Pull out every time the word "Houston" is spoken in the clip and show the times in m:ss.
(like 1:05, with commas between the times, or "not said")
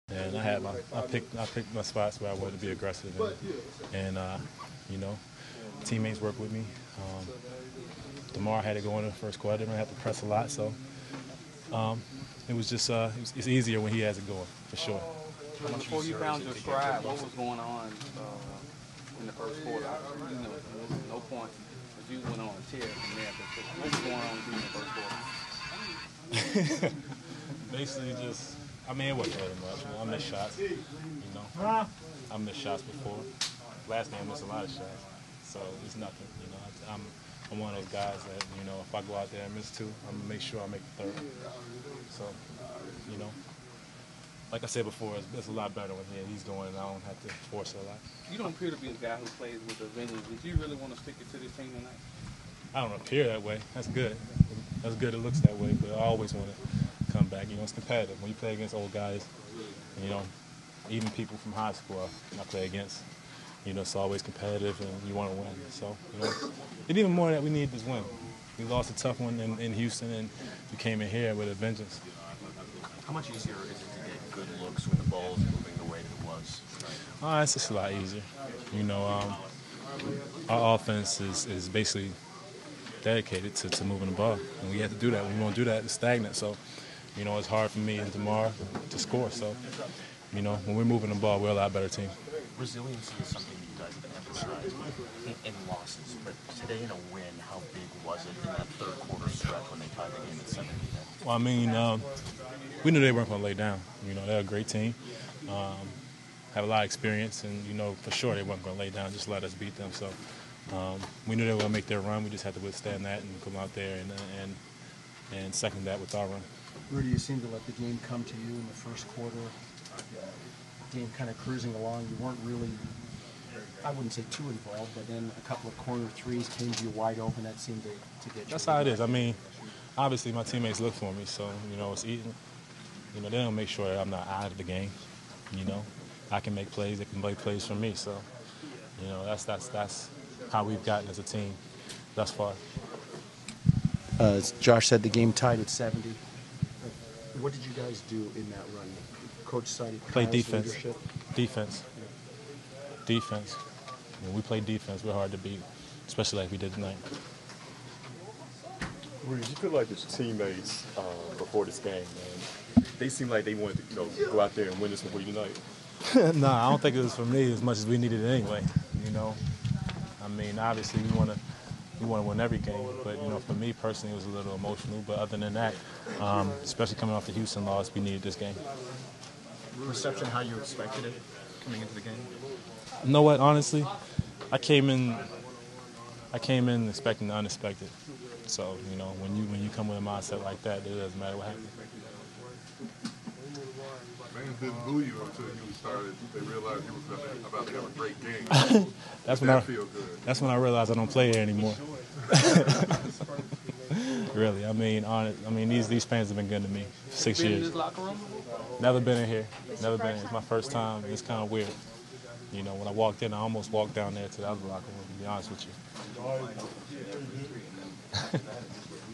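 1:09, 2:57.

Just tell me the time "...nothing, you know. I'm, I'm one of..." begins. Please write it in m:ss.
0:35.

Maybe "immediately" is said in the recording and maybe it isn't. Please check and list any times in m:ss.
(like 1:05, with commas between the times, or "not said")
not said.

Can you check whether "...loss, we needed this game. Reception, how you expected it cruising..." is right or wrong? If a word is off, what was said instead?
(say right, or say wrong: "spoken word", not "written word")
wrong: "coming", not "cruising".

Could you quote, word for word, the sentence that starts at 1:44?
You know, they're a great team.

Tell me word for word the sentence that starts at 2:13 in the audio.
You know, they don't make sure that I'm not out of the game.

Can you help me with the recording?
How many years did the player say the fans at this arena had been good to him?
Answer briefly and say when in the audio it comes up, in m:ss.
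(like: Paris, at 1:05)
6, at 3:27.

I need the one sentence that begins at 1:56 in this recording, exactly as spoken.
Rudy, you seemed to let the game come to you in the first quarter.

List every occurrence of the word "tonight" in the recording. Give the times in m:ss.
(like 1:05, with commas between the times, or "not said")
0:51, 2:36, 2:45.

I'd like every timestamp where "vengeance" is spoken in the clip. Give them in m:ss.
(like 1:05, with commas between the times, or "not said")
0:49, 1:11.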